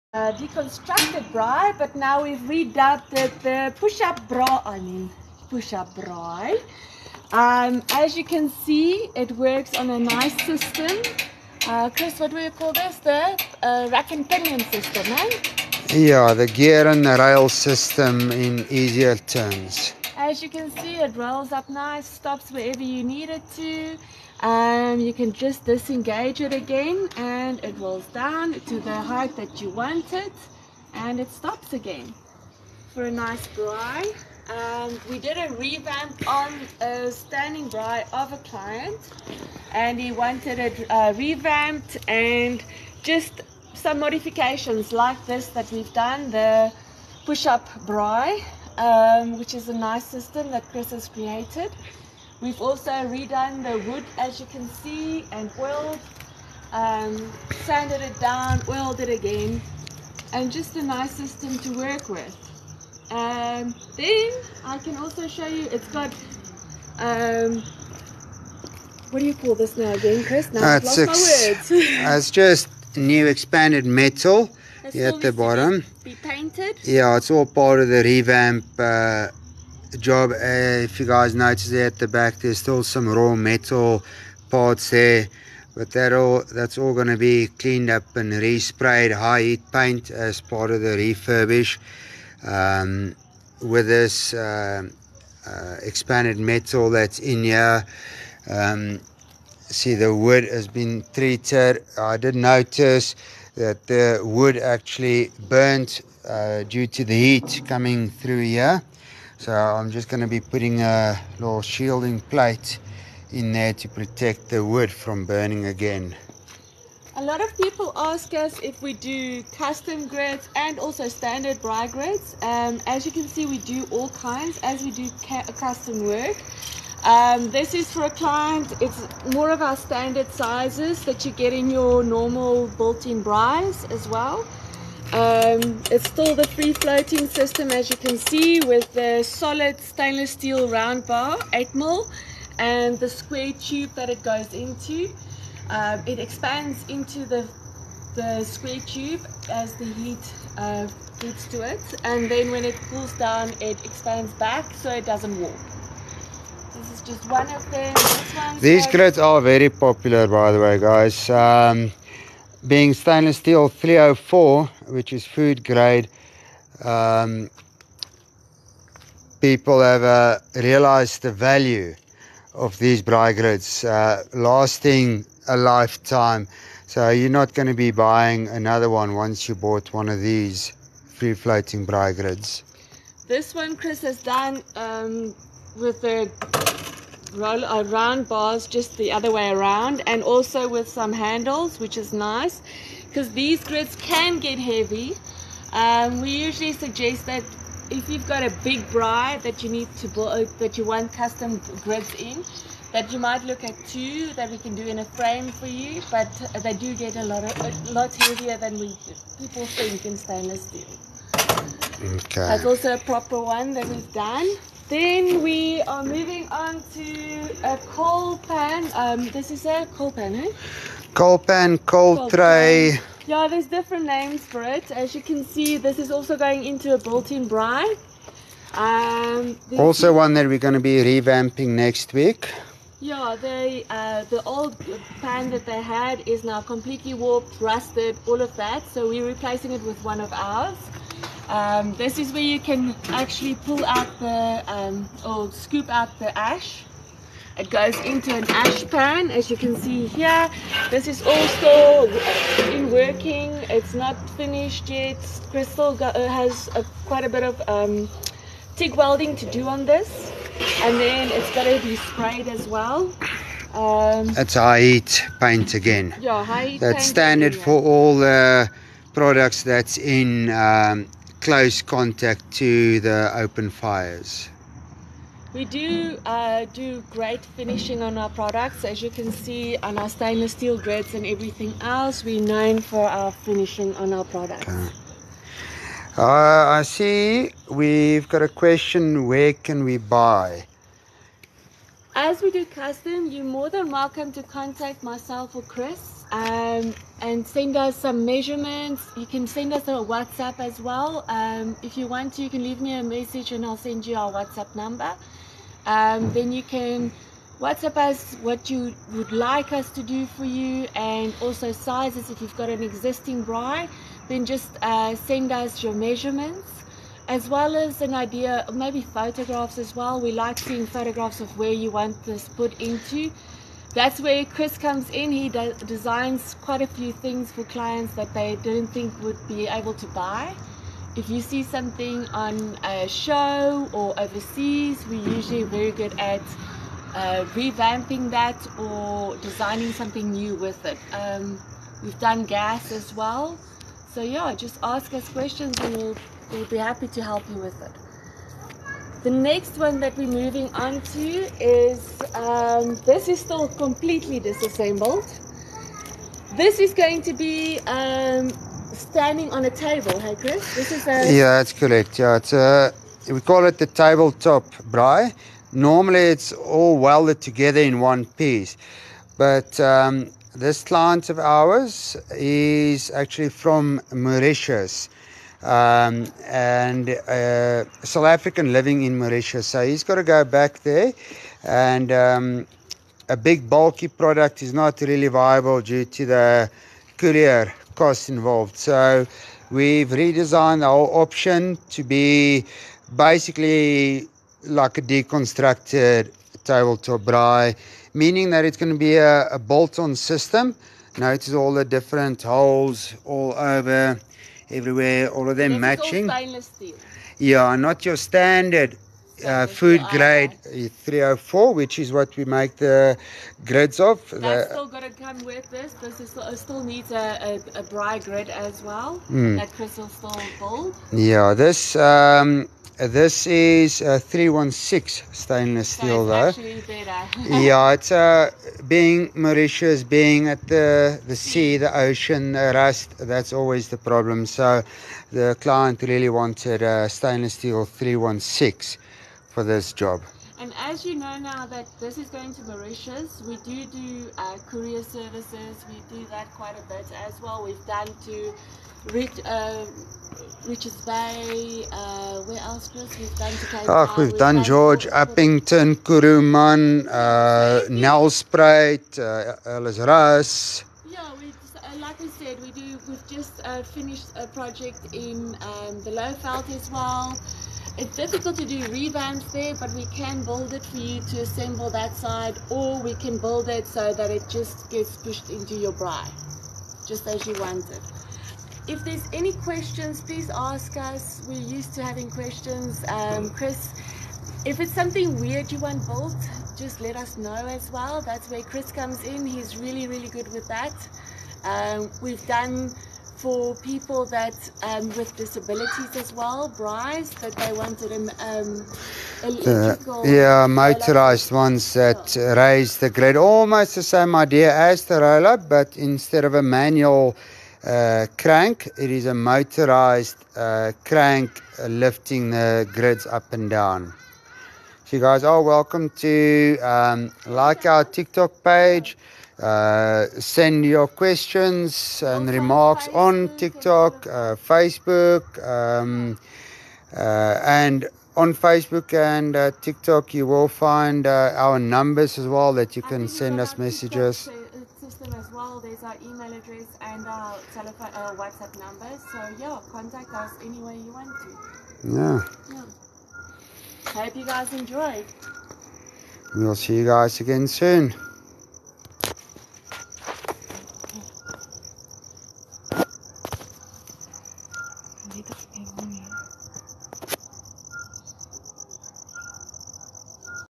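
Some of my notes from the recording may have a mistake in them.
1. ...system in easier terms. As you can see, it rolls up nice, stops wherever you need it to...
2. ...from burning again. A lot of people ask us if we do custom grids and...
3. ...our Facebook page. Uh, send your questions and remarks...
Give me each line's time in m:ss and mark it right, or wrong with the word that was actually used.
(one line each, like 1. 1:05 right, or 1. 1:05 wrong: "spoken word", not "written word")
1. 0:17 right
2. 1:54 right
3. 8:37 wrong: "TikTok", not "Facebook".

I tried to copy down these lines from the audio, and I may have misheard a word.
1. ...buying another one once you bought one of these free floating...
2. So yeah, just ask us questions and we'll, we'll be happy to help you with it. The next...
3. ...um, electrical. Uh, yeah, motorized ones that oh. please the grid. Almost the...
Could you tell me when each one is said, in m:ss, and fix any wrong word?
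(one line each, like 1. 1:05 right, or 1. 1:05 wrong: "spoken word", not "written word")
1. 2:57 right
2. 5:44 right
3. 8:18 wrong: "raise", not "please".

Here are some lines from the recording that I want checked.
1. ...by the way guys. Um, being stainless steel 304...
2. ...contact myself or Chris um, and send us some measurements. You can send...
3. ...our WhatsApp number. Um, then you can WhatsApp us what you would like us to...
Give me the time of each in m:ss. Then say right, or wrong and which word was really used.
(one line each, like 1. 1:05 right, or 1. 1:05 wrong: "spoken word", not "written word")
1. 2:40 right
2. 4:54 right
3. 5:04 right.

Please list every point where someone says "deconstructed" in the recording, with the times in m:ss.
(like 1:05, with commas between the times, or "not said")
0:00, 6:35.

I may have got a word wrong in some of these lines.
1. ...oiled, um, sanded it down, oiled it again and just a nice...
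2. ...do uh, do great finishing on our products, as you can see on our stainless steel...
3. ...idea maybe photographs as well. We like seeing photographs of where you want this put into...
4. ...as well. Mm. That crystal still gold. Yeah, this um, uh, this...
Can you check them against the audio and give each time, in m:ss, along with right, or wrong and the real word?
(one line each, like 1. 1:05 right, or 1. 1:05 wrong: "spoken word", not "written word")
1. 0:55 right
2. 4:35 right
3. 5:18 right
4. 6:58 right.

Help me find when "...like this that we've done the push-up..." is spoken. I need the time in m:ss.
0:44.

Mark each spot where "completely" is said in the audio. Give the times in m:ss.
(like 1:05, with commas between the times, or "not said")
3:56, 5:53.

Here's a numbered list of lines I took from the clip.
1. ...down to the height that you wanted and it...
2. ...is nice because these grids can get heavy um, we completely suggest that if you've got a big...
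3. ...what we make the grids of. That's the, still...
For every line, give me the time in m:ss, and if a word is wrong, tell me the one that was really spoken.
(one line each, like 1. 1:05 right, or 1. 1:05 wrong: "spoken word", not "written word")
1. 0:28 right
2. 3:11 wrong: "usually", not "completely"
3. 6:52 right.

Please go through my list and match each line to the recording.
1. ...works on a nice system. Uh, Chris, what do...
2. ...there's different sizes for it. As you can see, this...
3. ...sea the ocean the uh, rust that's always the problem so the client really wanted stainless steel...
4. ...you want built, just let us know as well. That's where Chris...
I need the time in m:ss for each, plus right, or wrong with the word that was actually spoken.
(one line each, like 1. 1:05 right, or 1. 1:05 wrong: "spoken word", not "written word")
1. 0:09 right
2. 3:43 wrong: "names", not "sizes"
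3. 7:11 right
4. 8:05 right.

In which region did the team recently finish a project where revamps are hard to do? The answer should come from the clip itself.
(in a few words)
Lowveld.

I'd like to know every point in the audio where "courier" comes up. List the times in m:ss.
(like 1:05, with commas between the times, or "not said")
6:27, 7:24.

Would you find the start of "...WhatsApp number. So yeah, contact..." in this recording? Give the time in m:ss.
8:58.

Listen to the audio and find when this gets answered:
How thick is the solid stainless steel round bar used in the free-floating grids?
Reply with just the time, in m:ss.
2:21.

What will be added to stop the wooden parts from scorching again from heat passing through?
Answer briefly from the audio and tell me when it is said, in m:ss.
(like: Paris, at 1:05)
Shielding plate, at 1:51.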